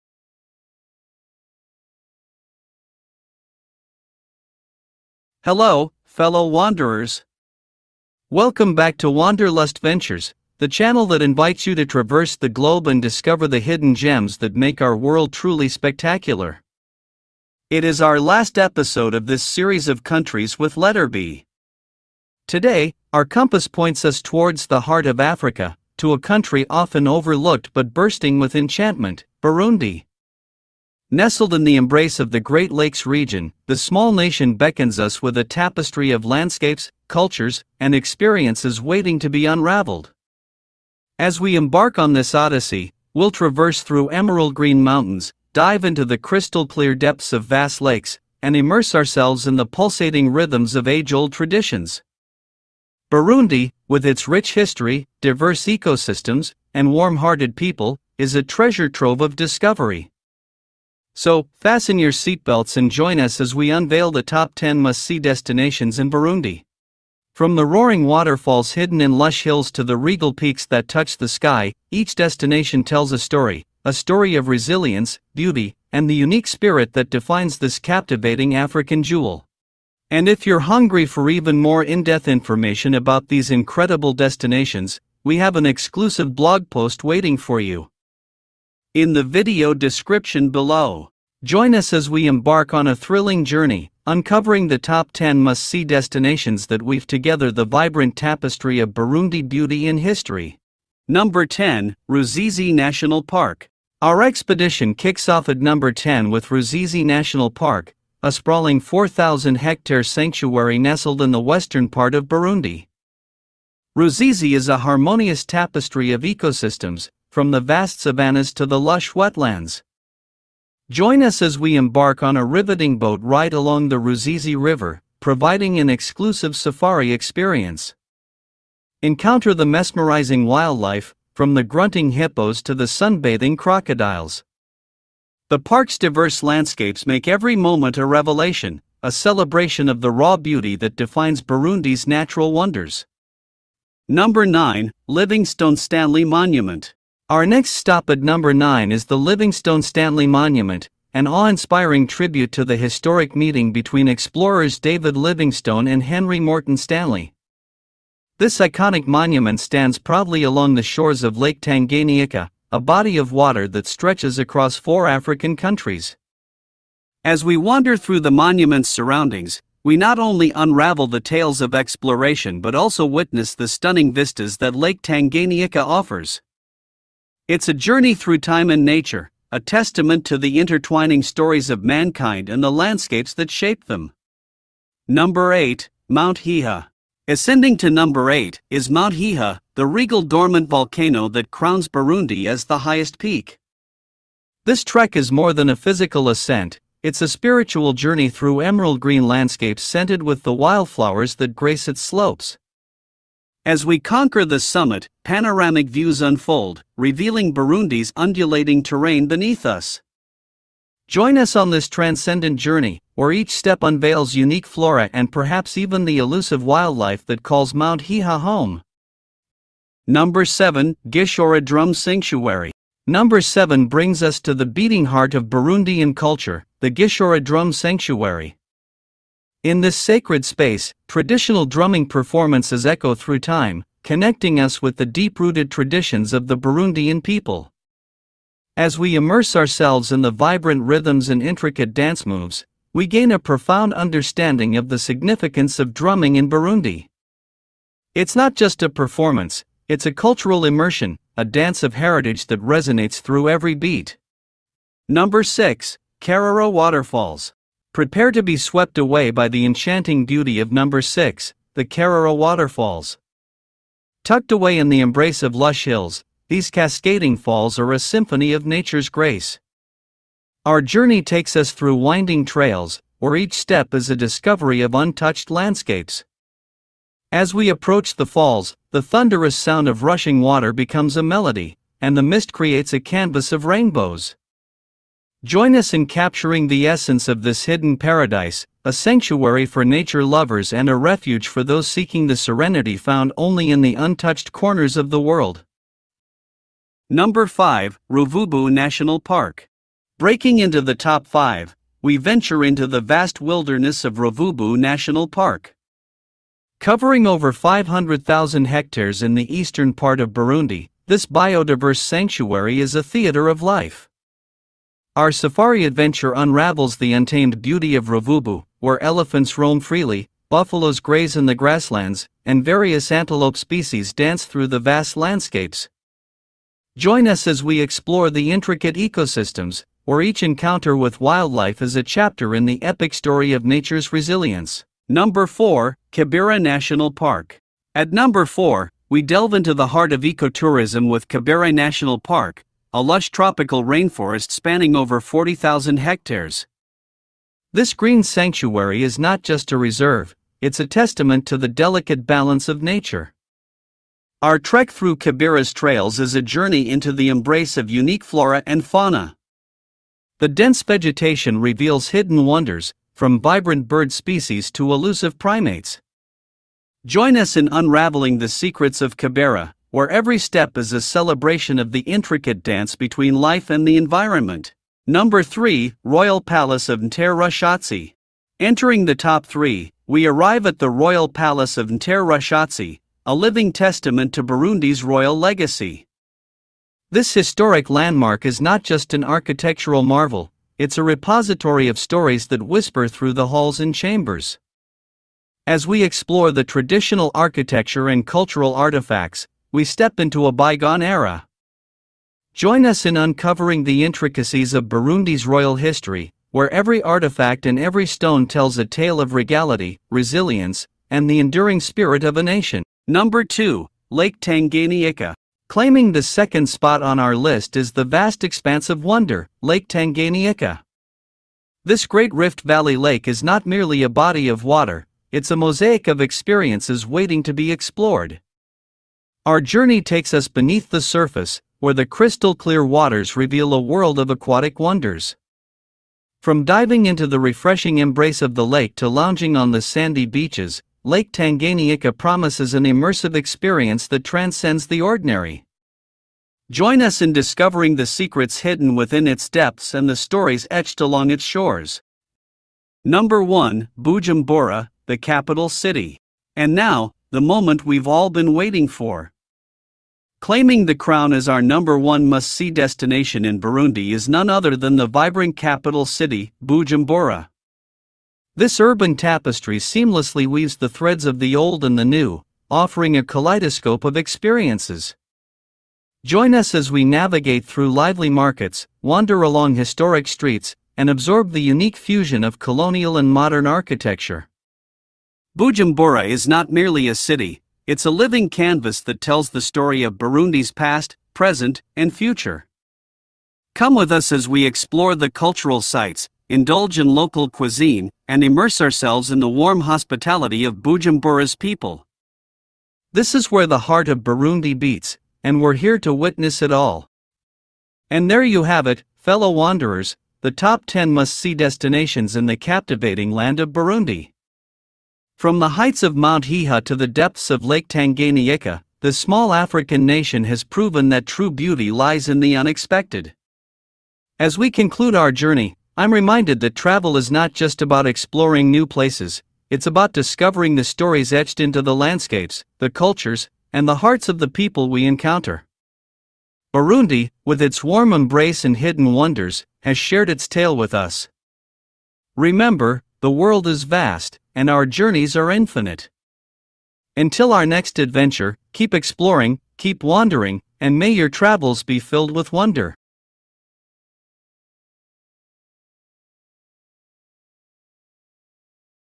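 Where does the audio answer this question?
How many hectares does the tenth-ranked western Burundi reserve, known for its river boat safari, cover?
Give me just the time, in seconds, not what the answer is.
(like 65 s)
108 s.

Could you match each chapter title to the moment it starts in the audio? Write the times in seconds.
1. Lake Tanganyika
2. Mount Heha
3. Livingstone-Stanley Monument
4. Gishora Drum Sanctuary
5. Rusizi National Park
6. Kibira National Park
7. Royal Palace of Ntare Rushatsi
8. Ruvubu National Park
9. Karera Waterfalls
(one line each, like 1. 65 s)
1. 413 s
2. 185 s
3. 144 s
4. 220 s
5. 101 s
6. 335 s
7. 375 s
8. 297 s
9. 255 s.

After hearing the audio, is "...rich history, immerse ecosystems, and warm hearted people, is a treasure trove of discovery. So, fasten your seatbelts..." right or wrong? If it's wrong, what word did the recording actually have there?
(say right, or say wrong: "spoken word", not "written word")
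wrong: "diverse", not "immerse".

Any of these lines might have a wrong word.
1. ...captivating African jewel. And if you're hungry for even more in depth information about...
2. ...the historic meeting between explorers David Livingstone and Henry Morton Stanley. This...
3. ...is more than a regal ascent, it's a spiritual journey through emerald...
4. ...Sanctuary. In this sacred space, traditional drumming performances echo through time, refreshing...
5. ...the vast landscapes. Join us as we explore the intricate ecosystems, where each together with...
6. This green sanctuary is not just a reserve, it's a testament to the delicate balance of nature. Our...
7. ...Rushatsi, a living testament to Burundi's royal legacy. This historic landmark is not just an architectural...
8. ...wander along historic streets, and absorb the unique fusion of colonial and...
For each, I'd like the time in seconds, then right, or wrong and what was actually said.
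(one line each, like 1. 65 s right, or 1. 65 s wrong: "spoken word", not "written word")
1. 77 s right
2. 152 s right
3. 195 s wrong: "physical", not "regal"
4. 227 s wrong: "connecting", not "refreshing"
5. 324 s wrong: "encounter", not "together"
6. 347 s right
7. 382 s right
8. 479 s right.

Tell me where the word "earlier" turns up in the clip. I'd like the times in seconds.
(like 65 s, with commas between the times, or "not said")
not said.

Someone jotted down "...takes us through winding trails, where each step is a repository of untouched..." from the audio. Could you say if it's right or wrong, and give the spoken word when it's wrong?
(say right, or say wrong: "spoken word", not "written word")
wrong: "discovery", not "repository".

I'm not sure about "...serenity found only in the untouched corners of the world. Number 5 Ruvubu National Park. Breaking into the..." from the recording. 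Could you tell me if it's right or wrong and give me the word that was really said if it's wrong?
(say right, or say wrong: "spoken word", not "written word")
right.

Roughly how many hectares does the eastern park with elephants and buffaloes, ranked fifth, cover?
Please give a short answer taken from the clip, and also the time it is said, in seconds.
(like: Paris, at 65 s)
500,000 hectares, at 307 s.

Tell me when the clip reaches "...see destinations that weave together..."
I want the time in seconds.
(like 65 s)
95 s.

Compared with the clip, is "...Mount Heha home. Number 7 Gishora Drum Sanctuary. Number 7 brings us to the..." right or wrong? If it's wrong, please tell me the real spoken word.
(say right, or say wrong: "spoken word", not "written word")
right.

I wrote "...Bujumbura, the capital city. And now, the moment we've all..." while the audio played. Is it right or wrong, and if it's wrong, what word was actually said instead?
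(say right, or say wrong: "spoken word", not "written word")
right.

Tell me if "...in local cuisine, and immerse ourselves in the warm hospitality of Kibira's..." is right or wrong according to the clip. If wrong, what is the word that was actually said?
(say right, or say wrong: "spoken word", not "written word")
wrong: "Bujumbura", not "Kibira".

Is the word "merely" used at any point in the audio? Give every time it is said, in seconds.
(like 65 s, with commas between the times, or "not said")
423 s, 486 s.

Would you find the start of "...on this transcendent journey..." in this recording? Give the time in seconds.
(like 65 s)
211 s.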